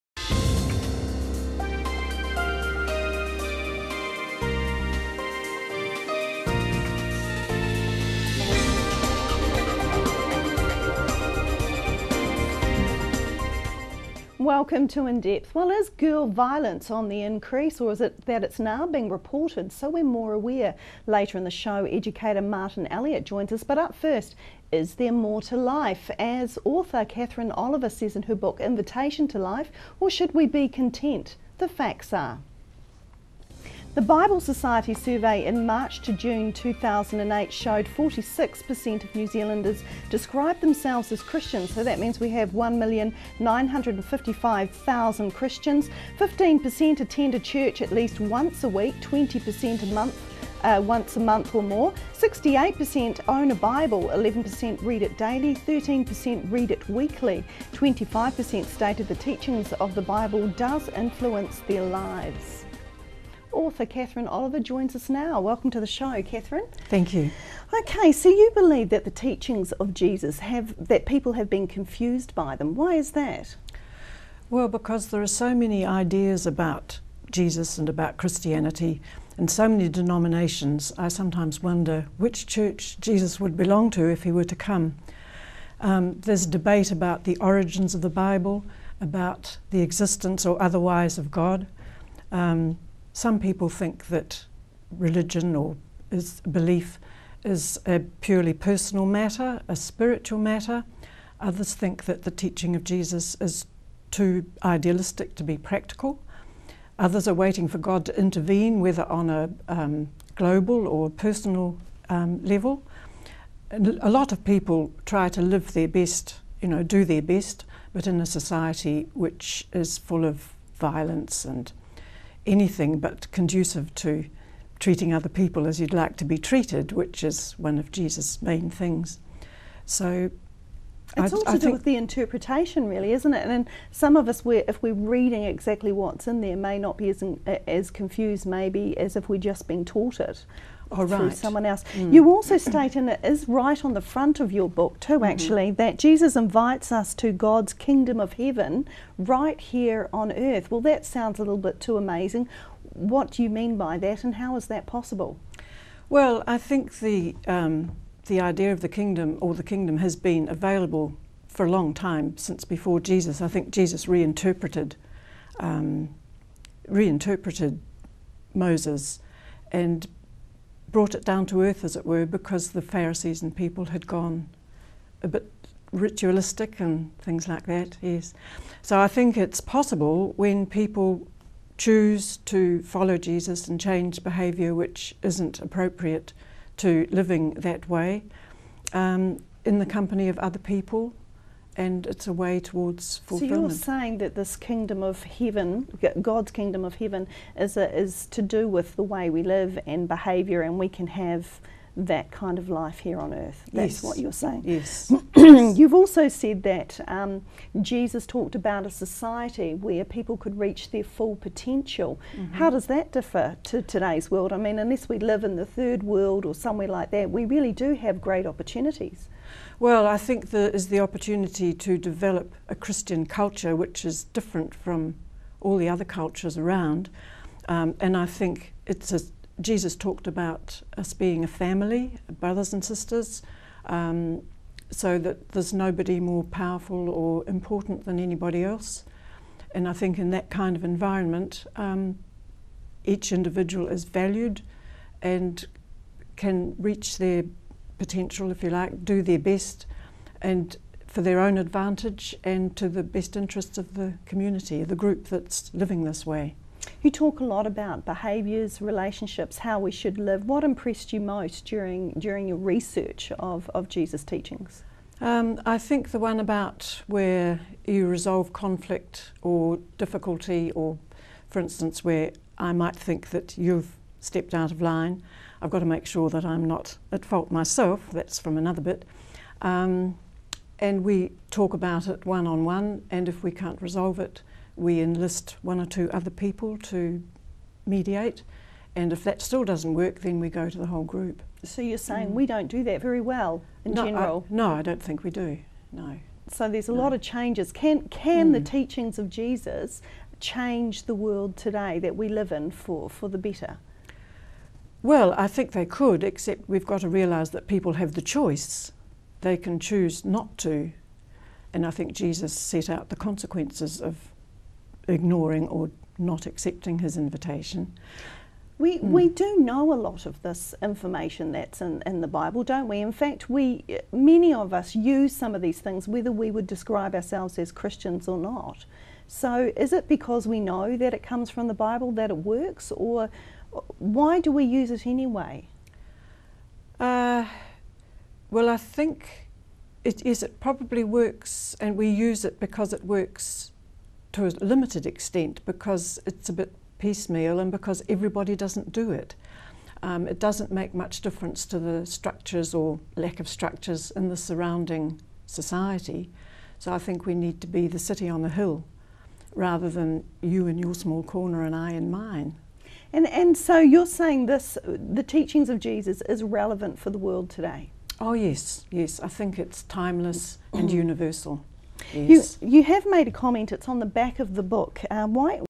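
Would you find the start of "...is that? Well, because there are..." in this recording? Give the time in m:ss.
1:12.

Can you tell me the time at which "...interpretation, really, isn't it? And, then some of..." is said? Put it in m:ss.
2:11.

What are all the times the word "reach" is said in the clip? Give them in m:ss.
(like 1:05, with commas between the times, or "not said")
3:30, 4:06.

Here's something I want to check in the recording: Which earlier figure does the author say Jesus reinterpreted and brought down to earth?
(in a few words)
Moses.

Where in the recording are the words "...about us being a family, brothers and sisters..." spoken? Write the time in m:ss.
3:50.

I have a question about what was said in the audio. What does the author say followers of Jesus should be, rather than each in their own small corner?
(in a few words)
the city on the hill.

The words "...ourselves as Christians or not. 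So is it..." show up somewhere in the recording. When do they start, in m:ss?
5:27.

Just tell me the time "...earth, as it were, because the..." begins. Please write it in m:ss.
2:51.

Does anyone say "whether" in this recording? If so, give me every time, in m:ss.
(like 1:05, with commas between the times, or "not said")
1:48, 5:26.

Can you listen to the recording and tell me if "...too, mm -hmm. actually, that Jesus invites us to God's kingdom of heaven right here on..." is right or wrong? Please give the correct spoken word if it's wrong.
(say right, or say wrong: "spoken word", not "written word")
right.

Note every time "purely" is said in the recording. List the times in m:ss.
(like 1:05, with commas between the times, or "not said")
1:38.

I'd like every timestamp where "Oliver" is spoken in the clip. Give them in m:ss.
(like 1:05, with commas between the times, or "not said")
0:27, 1:04.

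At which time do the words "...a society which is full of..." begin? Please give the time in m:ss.
1:58.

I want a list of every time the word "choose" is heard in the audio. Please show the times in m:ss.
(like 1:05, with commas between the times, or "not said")
3:01, 5:09.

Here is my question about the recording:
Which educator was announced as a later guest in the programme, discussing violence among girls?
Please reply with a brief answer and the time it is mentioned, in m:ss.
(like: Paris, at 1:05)
Martin Elliott, at 0:22.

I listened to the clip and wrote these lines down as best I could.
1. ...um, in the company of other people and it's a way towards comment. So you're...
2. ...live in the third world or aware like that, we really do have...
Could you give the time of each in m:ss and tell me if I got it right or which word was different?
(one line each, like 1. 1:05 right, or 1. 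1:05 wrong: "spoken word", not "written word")
1. 3:08 wrong: "fulfillment", not "comment"
2. 3:35 wrong: "somewhere", not "aware".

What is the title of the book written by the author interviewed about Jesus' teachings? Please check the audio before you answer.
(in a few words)
Invitation to Life.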